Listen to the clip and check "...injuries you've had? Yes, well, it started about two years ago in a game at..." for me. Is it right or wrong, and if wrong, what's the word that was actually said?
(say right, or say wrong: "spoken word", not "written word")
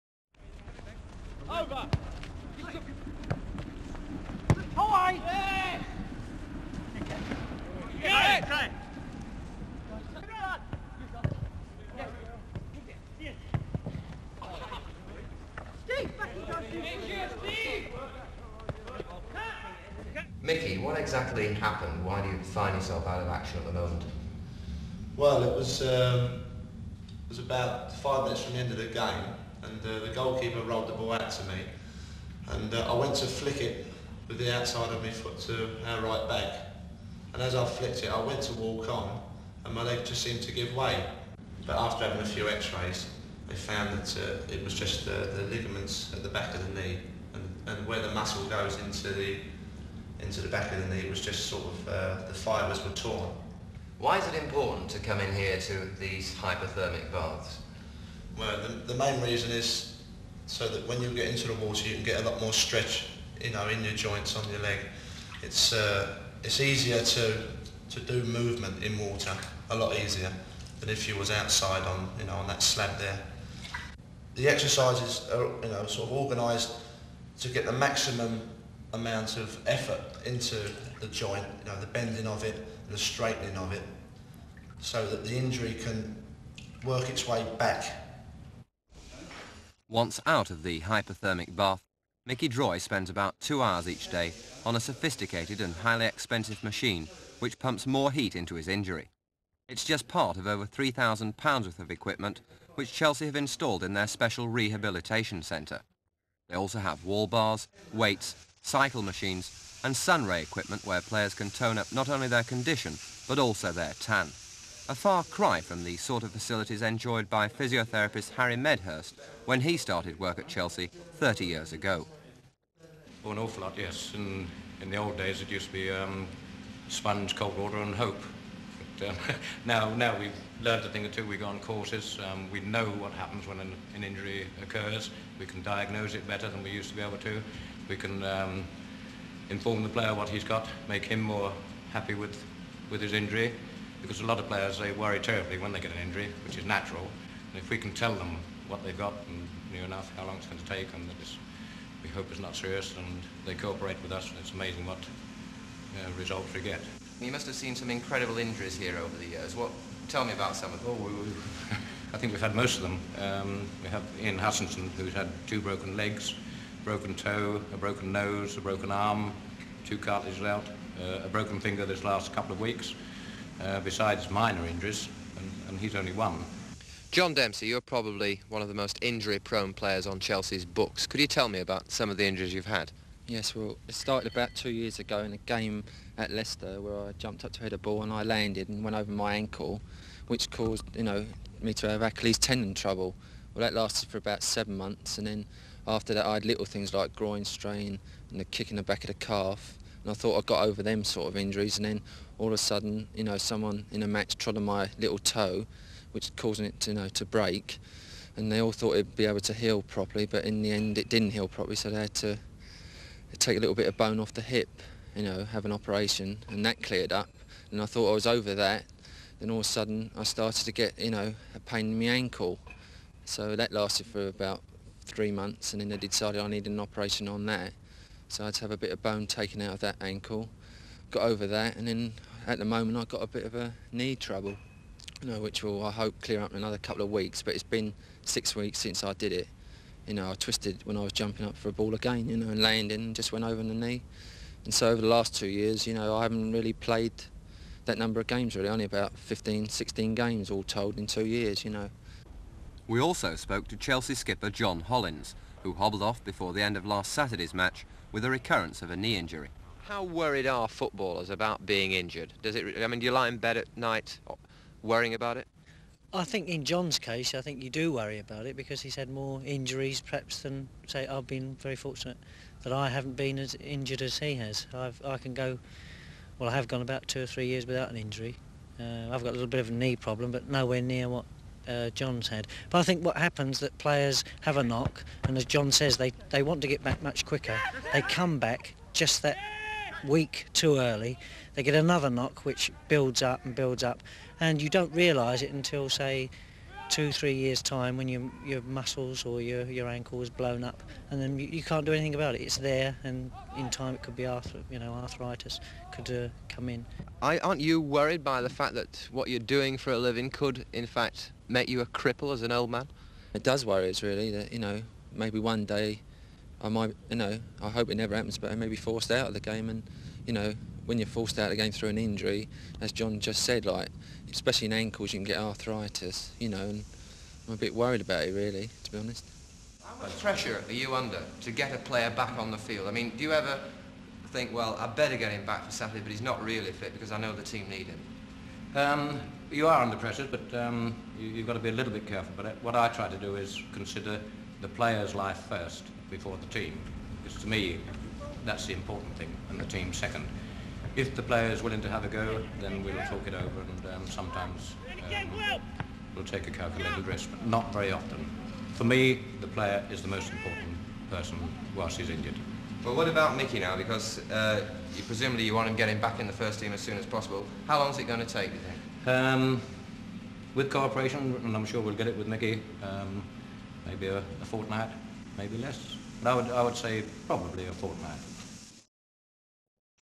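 right.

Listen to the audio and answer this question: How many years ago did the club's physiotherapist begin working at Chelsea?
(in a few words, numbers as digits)
30.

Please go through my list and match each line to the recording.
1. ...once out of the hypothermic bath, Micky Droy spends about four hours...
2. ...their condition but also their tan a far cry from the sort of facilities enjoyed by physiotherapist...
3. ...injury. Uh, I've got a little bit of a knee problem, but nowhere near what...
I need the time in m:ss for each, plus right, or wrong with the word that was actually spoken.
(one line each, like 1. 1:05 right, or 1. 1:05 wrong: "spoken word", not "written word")
1. 1:29 wrong: "two", not "four"
2. 1:52 right
3. 4:37 right.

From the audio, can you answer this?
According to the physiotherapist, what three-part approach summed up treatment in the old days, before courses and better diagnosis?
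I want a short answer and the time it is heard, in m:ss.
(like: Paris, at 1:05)
Sponge, cold water, and hope, at 2:06.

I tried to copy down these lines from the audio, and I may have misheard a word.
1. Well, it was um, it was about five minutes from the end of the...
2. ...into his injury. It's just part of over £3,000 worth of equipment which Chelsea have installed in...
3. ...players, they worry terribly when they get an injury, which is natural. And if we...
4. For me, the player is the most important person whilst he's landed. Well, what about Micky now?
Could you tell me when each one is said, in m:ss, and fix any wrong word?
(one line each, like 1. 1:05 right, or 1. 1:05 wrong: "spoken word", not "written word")
1. 0:25 right
2. 1:38 right
3. 2:24 right
4. 5:58 wrong: "injured", not "landed".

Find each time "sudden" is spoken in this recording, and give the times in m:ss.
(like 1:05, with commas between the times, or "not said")
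3:22, 3:39.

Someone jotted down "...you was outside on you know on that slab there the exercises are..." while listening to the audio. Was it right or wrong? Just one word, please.
right.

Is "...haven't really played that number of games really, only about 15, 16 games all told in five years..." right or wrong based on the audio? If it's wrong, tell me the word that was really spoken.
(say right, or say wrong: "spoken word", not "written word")
wrong: "two", not "five".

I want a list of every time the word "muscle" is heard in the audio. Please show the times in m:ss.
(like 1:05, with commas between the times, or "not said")
0:48, 4:58.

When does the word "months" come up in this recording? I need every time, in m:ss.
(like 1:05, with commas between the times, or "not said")
3:14, 3:45.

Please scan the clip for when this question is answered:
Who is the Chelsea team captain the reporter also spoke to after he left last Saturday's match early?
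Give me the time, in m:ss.
4:14.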